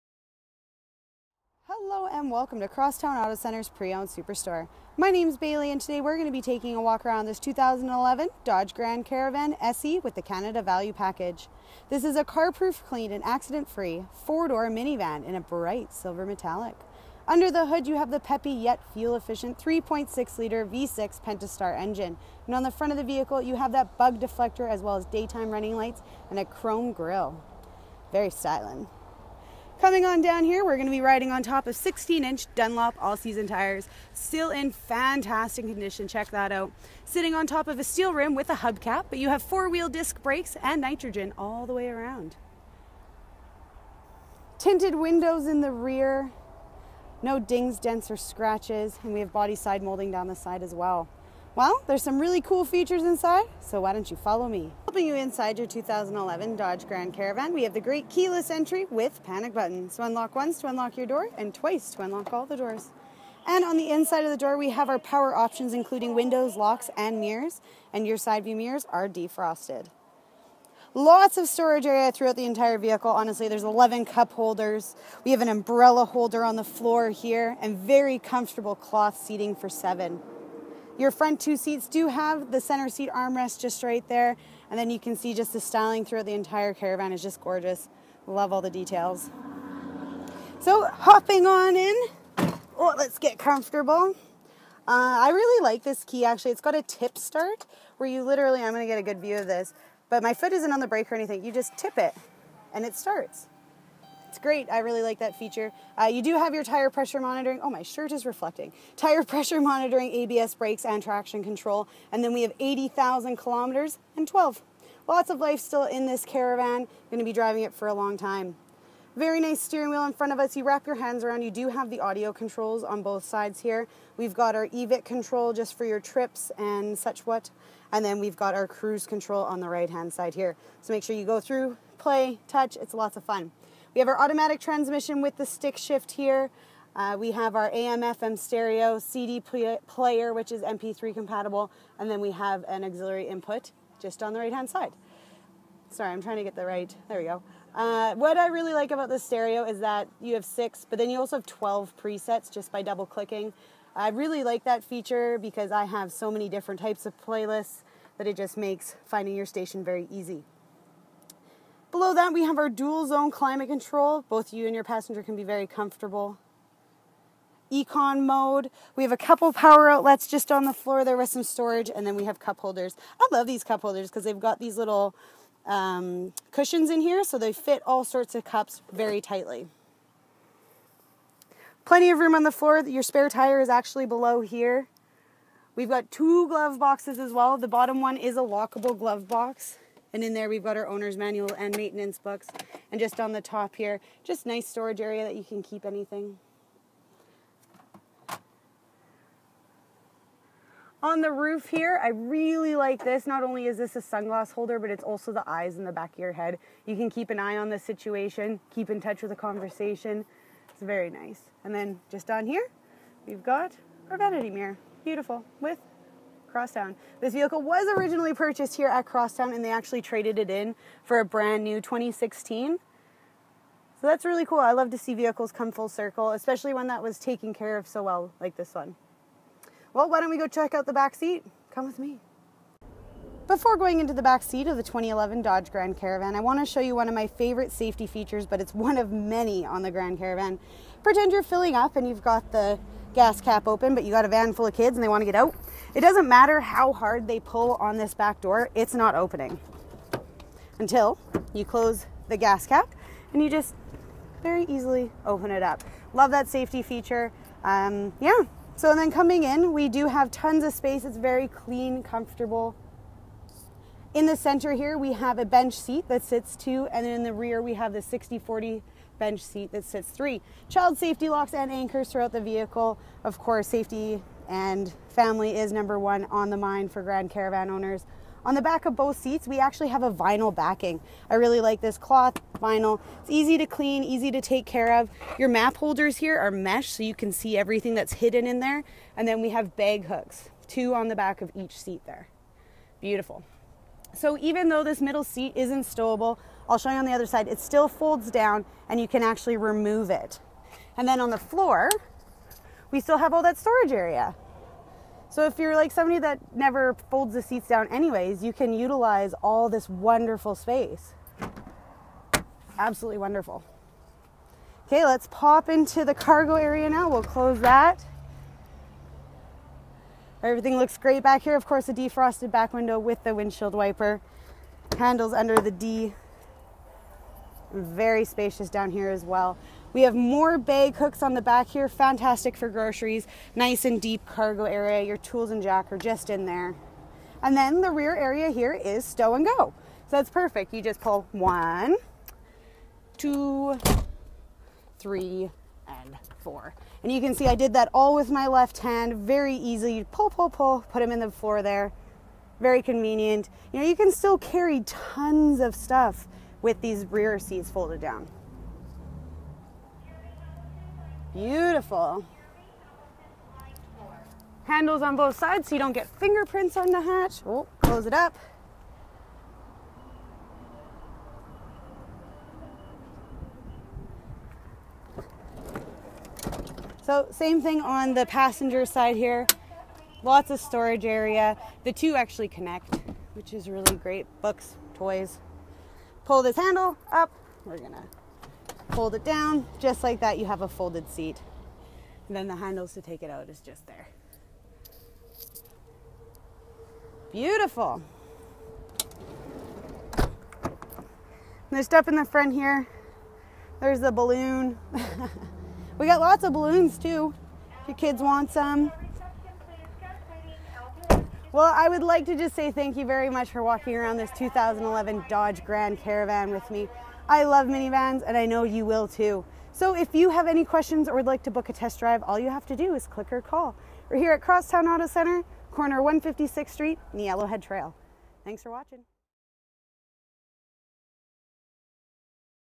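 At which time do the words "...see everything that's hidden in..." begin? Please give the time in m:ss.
4:47.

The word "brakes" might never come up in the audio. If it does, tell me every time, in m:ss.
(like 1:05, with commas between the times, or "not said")
0:40, 1:40, 1:50.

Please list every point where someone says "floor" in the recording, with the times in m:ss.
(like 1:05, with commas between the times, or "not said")
1:16, 2:50, 3:02, 5:01, 5:51.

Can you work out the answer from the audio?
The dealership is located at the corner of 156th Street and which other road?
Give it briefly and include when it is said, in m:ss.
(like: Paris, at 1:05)
Yellowhead Trail, at 7:07.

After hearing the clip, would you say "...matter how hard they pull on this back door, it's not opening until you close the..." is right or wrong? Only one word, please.
right.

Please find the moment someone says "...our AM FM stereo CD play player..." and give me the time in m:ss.
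2:17.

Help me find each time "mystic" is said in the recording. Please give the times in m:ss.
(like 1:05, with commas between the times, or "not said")
not said.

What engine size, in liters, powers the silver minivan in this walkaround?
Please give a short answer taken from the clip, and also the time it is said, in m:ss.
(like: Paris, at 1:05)
3.6-liter, at 0:19.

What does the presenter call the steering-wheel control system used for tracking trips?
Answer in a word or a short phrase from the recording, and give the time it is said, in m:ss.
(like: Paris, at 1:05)
EVIC, at 2:04.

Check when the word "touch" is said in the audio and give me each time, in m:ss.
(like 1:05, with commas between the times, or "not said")
2:12, 3:29.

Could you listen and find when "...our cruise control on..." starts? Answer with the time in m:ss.
2:08.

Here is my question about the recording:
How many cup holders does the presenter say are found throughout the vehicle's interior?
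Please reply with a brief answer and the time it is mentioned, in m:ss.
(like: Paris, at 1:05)
11, at 1:13.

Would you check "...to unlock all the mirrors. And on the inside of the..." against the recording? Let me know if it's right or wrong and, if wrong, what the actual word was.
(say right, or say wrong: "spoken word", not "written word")
wrong: "doors", not "mirrors".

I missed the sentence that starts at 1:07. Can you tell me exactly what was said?
And your side view mirrors are defrosted.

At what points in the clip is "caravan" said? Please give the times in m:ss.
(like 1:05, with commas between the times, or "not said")
0:09, 0:57, 1:26, 1:56, 3:55, 4:00, 4:37, 6:55.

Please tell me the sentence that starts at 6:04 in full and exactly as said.
Handles on both sides so you don't get fingerprints on the hatch.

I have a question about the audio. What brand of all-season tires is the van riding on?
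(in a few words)
Dunlop.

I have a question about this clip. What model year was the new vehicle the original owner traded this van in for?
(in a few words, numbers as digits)
2016.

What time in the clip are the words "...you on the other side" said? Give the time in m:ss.
4:56.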